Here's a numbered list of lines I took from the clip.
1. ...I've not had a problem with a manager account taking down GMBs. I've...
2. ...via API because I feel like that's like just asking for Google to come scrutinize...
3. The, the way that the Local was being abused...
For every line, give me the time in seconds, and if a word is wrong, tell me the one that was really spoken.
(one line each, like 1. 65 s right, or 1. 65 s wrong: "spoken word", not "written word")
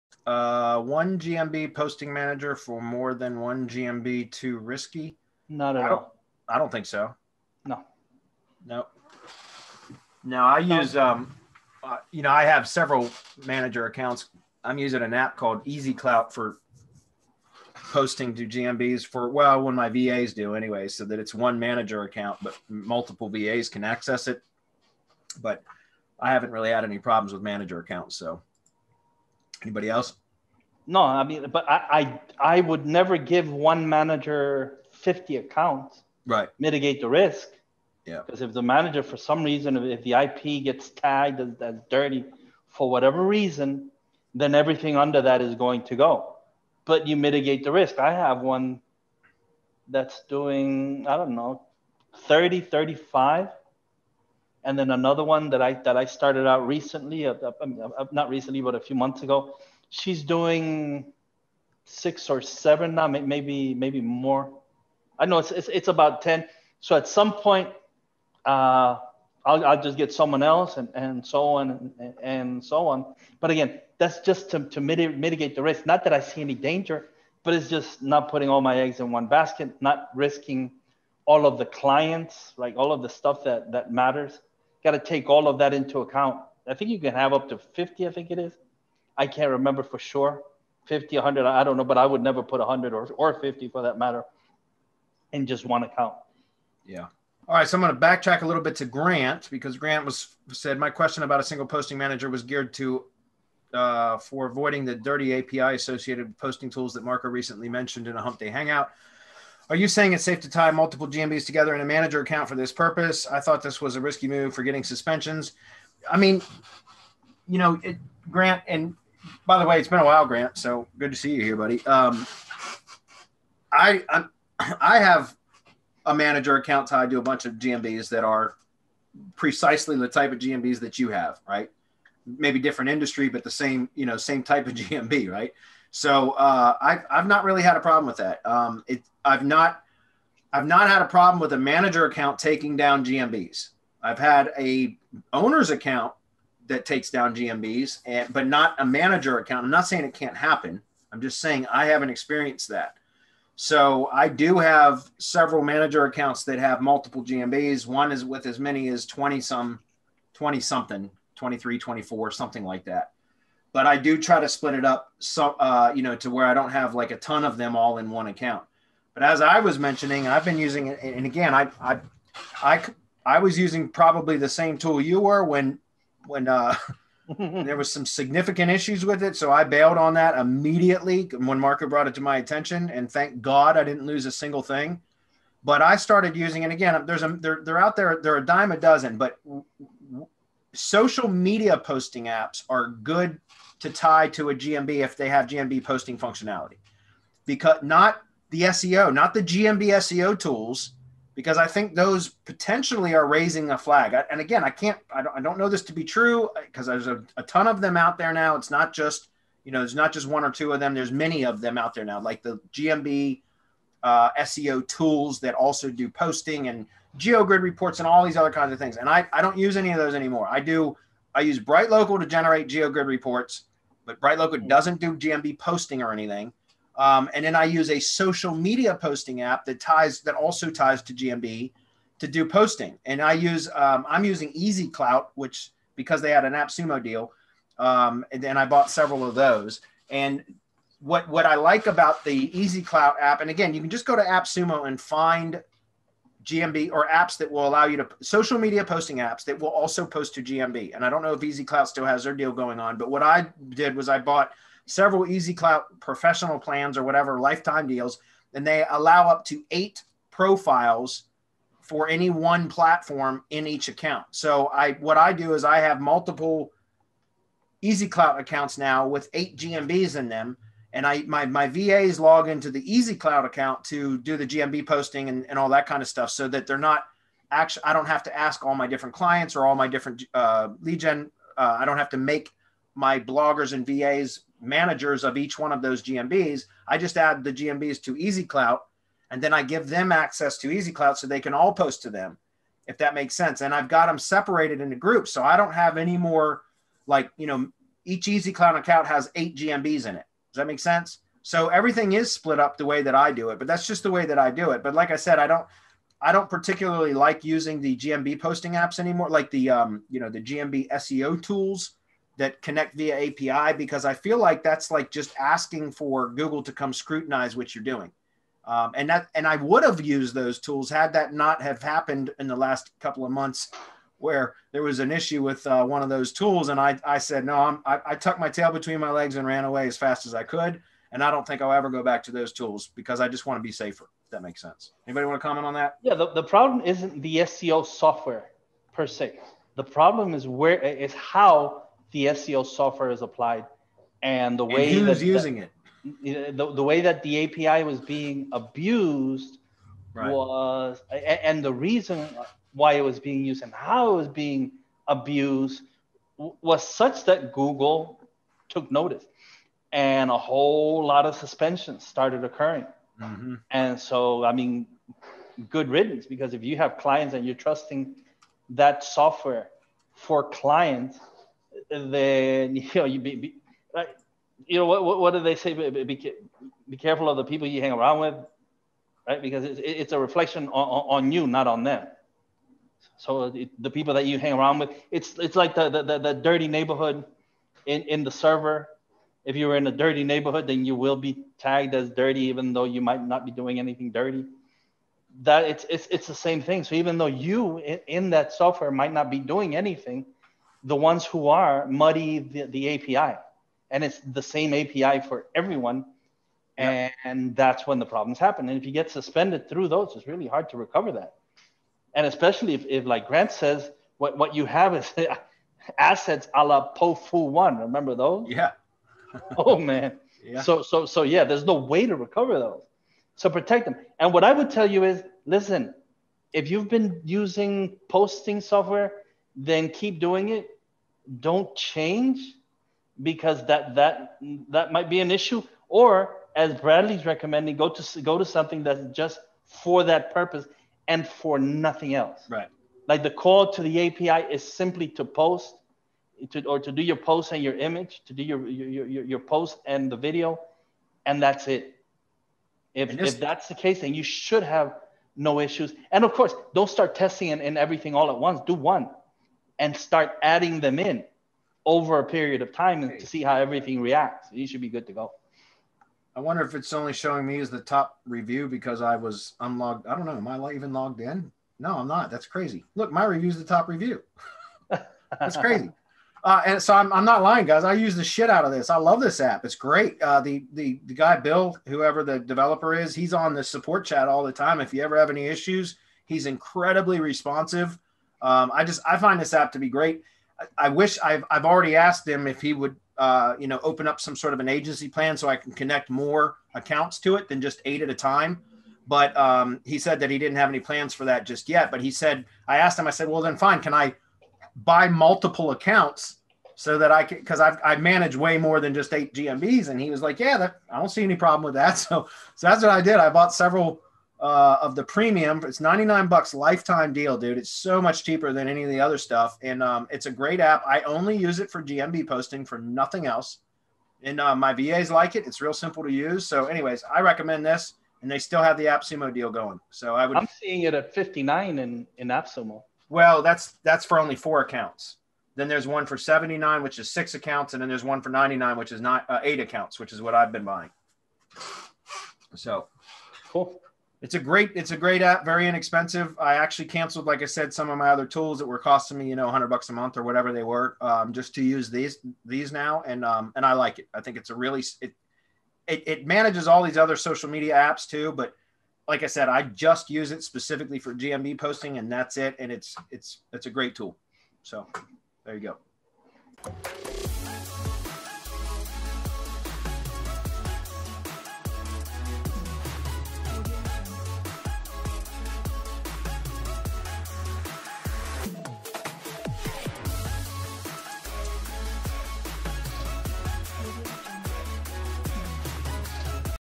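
1. 140 s right
2. 312 s right
3. 346 s wrong: "API", not "Local".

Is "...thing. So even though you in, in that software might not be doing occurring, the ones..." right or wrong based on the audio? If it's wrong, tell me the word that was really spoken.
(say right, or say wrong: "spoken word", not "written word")
wrong: "anything", not "occurring".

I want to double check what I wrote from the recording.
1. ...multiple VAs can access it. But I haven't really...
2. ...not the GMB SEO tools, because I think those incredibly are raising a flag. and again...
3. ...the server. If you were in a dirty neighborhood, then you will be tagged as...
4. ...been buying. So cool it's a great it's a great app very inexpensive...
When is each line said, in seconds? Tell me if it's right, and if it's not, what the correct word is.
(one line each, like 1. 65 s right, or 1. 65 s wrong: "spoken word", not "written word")
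1. 22 s right
2. 199 s wrong: "potentially", not "incredibly"
3. 388 s right
4. 540 s right.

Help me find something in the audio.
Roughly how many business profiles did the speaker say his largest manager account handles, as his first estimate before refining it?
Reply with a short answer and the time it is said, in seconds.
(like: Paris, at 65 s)
30, at 52 s.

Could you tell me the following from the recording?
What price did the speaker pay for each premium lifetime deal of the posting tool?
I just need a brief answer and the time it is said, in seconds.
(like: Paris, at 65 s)
$99, at 515 s.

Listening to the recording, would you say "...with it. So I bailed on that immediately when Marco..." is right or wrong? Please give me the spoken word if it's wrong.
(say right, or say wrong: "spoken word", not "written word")
right.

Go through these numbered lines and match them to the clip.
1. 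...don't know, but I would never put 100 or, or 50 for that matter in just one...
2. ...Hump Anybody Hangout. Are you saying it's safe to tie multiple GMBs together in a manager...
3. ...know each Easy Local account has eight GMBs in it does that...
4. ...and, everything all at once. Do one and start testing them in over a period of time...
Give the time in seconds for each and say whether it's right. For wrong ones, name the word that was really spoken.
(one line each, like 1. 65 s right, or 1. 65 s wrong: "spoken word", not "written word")
1. 91 s right
2. 108 s wrong: "Day", not "Anybody"
3. 297 s wrong: "Clout", not "Local"
4. 457 s wrong: "adding", not "testing".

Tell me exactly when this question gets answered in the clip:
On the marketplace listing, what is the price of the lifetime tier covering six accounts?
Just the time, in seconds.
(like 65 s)
536 s.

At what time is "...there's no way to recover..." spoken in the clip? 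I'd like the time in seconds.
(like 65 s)
421 s.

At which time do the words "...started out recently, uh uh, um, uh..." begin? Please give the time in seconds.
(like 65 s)
56 s.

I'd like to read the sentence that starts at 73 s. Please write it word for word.
But again, that's just to to mitigate mitigate the risk.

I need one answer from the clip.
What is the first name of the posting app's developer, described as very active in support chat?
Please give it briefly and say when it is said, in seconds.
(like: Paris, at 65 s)
Bill, at 481 s.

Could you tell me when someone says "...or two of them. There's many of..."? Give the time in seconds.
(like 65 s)
210 s.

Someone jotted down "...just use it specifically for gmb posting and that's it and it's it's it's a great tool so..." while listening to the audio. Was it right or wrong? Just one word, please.
right.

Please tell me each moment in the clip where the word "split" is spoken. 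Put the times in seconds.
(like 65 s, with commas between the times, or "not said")
164 s, 302 s.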